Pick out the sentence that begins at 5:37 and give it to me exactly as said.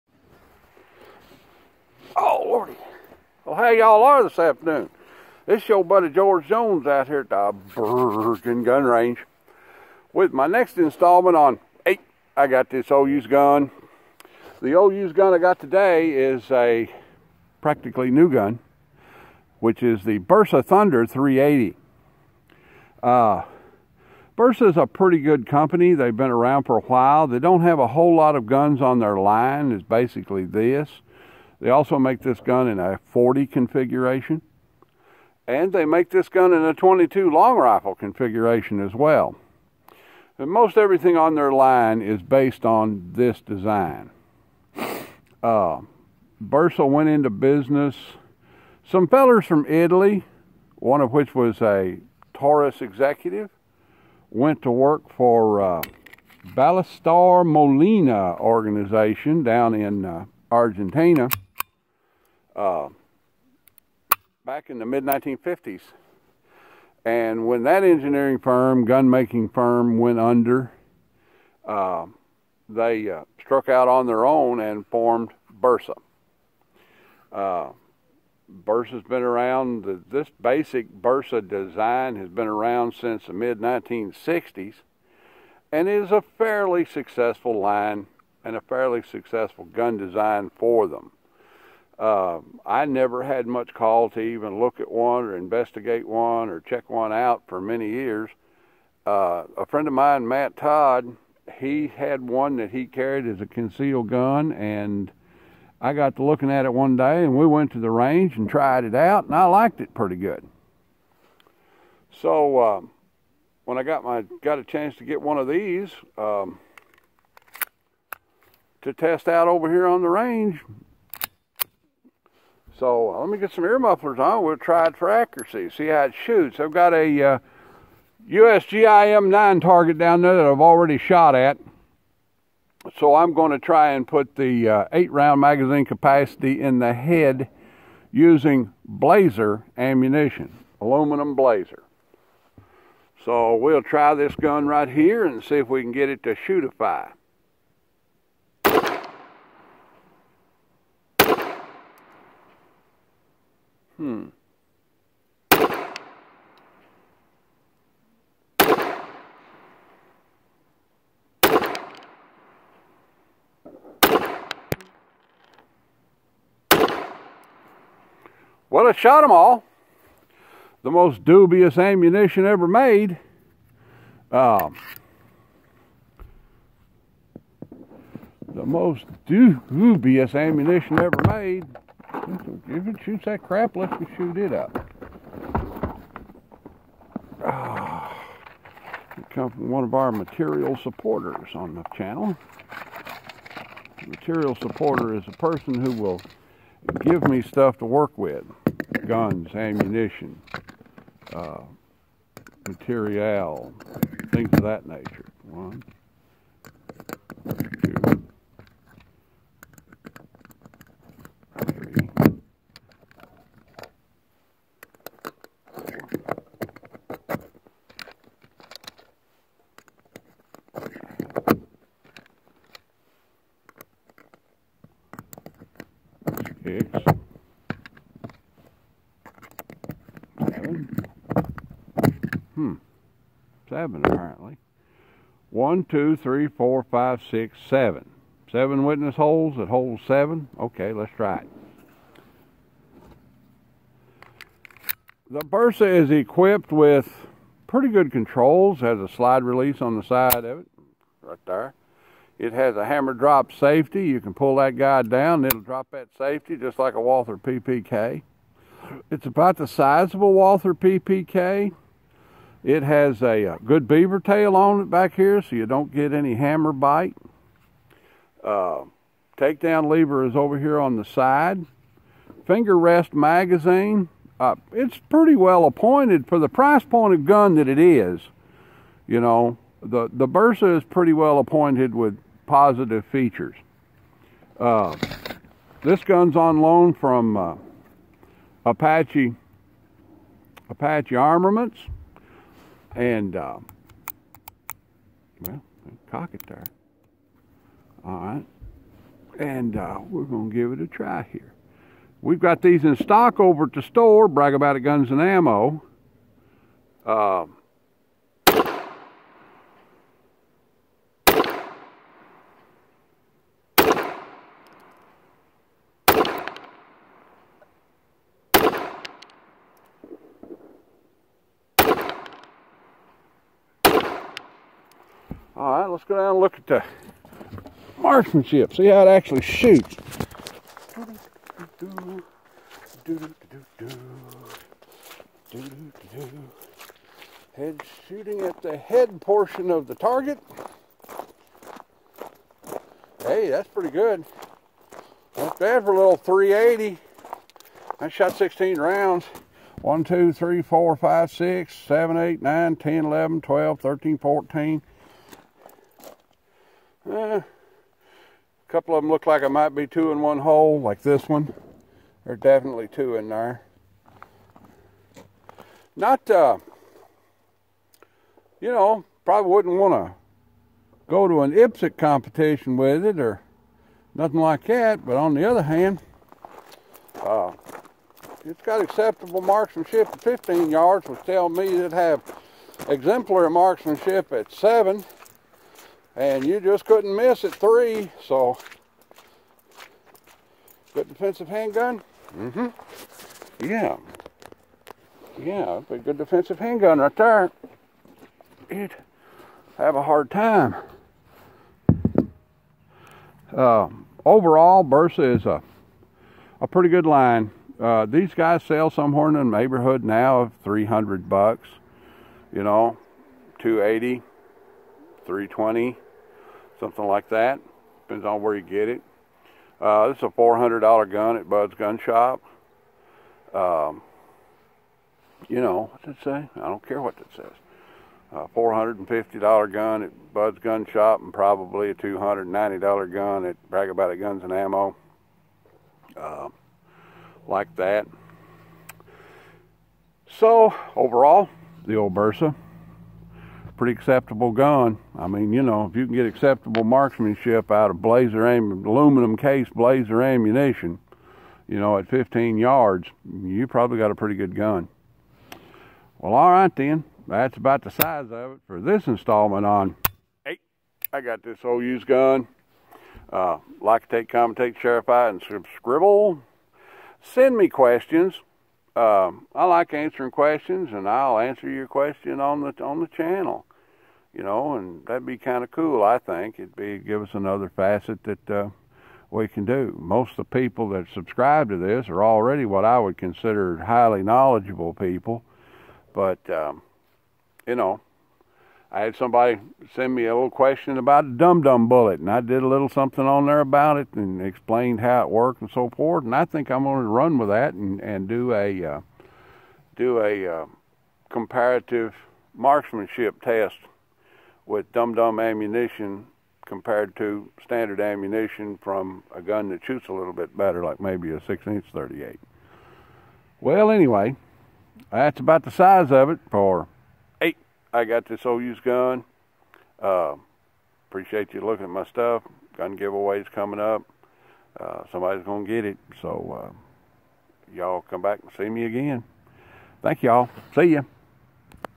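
Head shooting at the head portion of the target.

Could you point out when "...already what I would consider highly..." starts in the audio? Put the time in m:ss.
8:02.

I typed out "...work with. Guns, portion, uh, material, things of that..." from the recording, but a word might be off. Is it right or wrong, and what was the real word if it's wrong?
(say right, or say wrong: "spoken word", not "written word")
wrong: "ammunition", not "portion".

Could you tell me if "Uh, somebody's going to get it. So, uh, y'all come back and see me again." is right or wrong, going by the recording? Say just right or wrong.
right.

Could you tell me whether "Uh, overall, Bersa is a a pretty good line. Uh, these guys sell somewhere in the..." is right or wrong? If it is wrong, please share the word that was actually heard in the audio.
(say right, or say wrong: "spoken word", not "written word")
right.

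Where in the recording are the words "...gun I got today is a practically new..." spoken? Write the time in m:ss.
0:15.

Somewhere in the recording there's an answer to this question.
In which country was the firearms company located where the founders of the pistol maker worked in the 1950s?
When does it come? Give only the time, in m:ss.
1:00.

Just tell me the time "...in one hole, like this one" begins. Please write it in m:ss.
6:00.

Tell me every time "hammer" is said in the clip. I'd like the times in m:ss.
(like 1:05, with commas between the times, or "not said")
4:12, 4:26.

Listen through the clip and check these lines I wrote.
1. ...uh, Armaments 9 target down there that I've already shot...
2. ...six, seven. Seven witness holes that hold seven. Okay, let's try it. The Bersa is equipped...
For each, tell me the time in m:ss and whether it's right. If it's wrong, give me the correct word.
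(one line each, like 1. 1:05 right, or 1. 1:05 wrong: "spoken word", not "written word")
1. 2:07 wrong: "USGIM", not "Armaments"
2. 3:57 right.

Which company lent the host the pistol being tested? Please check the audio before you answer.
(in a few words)
Apache Armaments.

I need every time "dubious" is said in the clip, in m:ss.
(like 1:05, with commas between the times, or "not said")
2:51, 2:59.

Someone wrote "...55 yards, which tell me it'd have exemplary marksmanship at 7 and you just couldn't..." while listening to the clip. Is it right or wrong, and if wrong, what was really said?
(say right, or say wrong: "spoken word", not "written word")
wrong: "15", not "55".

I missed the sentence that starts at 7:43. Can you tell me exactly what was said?
Uh, like, take, commentate, share, fight, and scribble.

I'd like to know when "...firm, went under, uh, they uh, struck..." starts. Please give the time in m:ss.
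1:09.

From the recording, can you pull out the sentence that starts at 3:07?
Oh, it from one of our material supporters on the channel.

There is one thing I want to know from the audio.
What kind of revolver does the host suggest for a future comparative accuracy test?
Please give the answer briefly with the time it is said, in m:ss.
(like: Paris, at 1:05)
6 inch 38, at 8:31.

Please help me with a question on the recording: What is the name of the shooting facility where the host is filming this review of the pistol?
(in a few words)
Virgin Gun Range.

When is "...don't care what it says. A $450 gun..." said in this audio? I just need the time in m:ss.
7:06.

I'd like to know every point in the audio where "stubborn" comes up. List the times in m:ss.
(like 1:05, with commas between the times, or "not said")
not said.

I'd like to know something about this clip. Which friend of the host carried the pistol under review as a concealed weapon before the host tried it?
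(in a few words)
Matt Todd.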